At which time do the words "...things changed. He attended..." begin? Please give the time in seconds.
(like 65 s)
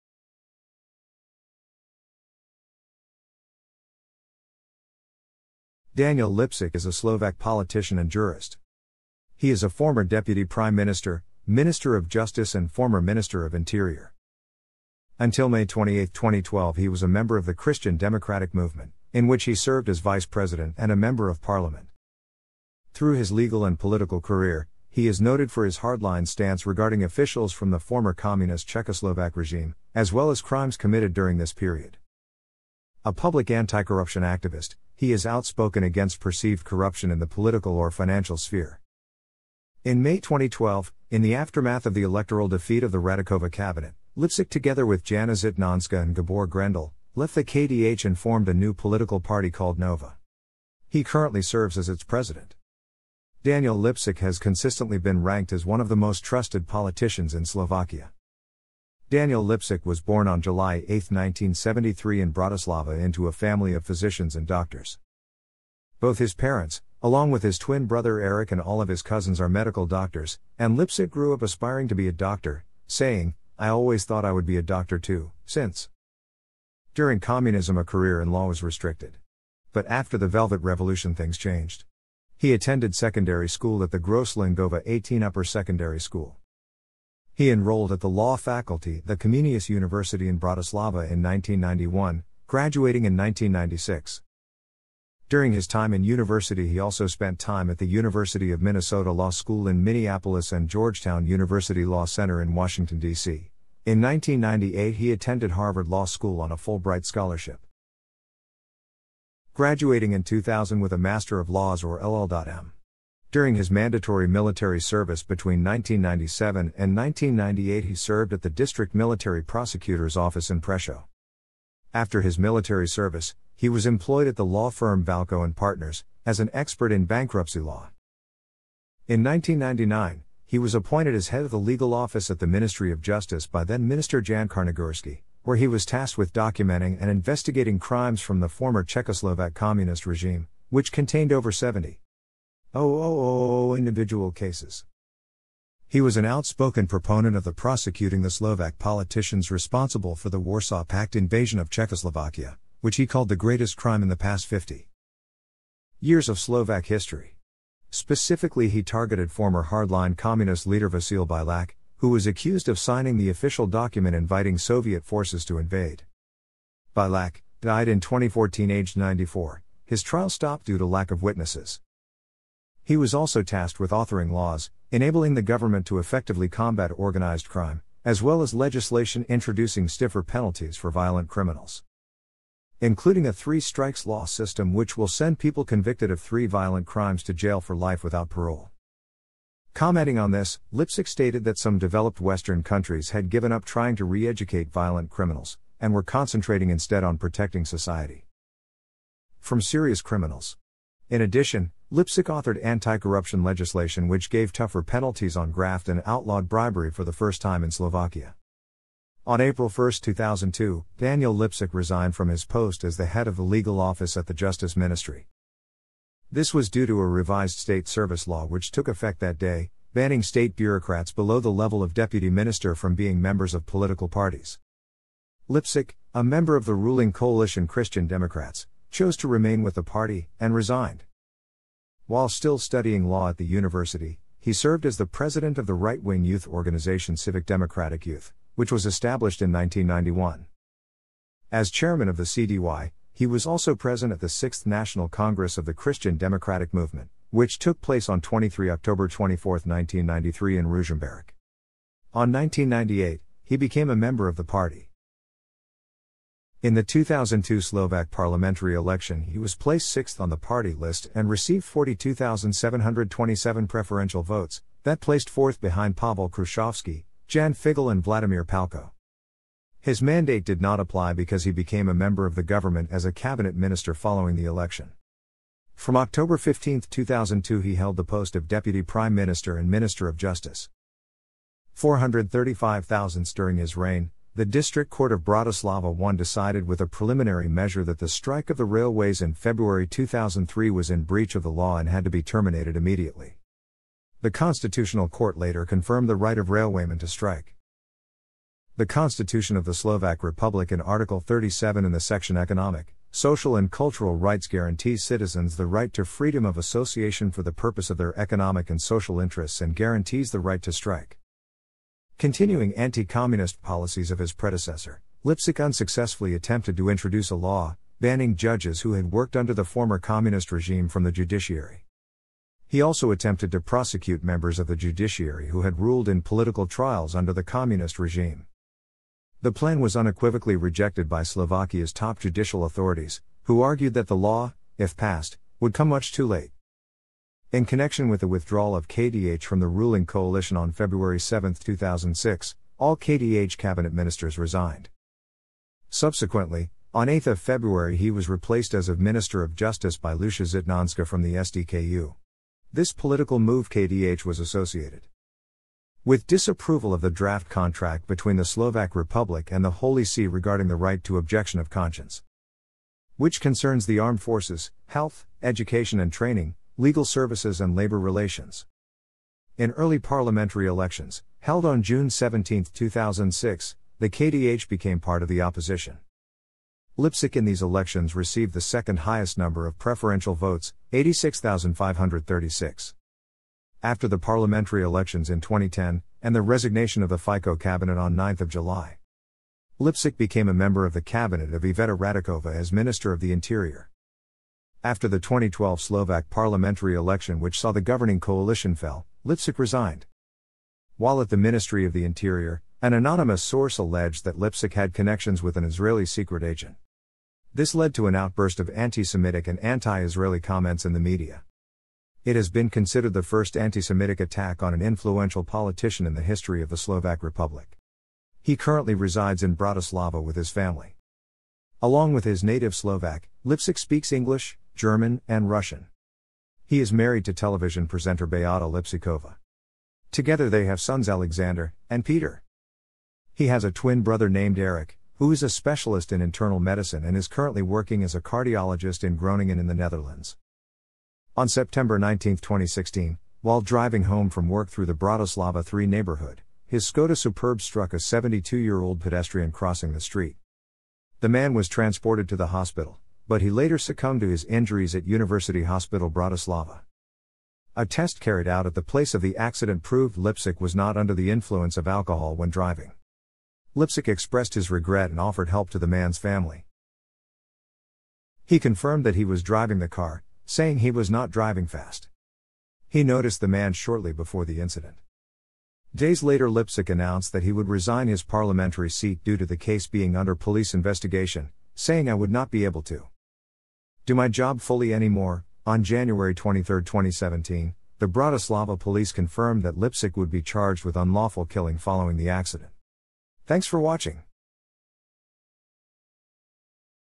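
81 s.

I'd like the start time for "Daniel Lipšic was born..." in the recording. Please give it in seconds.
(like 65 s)
59 s.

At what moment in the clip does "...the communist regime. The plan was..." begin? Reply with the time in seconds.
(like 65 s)
327 s.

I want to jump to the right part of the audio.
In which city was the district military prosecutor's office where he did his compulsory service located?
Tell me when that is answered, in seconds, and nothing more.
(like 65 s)
120 s.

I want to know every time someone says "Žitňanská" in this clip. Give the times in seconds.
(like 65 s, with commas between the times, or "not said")
45 s, 350 s.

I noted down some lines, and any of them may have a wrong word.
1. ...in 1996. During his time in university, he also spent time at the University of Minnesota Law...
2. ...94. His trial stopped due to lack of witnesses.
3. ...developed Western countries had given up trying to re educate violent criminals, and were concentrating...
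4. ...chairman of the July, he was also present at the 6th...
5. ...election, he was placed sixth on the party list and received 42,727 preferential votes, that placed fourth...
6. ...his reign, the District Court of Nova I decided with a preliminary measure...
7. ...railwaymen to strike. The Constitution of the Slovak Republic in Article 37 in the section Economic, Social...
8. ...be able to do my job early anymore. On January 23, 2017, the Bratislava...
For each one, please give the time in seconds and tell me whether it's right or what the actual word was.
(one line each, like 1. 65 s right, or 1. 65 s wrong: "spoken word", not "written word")
1. 93 s right
2. 168 s right
3. 191 s right
4. 241 s wrong: "CDY", not "July"
5. 258 s right
6. 283 s wrong: "Bratislava", not "Nova"
7. 296 s right
8. 482 s wrong: "fully", not "early".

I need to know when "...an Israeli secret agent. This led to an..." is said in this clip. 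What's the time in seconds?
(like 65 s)
405 s.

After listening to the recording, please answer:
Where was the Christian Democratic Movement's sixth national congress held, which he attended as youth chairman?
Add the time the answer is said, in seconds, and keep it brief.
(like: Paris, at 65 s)
Ružomberok, at 250 s.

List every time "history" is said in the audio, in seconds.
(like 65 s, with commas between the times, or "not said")
156 s, 416 s.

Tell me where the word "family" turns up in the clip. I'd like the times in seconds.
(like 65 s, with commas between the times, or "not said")
63 s, 420 s, 466 s.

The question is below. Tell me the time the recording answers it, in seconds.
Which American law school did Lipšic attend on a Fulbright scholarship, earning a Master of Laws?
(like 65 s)
105 s.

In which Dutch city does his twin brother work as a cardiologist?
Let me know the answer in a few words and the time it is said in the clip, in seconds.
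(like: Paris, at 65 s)
Groningen, at 439 s.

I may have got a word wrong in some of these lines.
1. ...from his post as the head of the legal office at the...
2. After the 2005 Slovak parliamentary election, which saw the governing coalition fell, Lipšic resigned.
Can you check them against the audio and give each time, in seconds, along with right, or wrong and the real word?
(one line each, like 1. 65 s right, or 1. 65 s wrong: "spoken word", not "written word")
1. 212 s right
2. 394 s wrong: "2012", not "2005".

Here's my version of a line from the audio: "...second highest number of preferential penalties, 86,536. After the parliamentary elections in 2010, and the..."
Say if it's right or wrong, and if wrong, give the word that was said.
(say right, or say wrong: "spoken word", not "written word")
wrong: "votes", not "penalties".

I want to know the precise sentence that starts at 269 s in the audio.
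His mandate did not apply because he became a member of the government as a cabinet minister following the election.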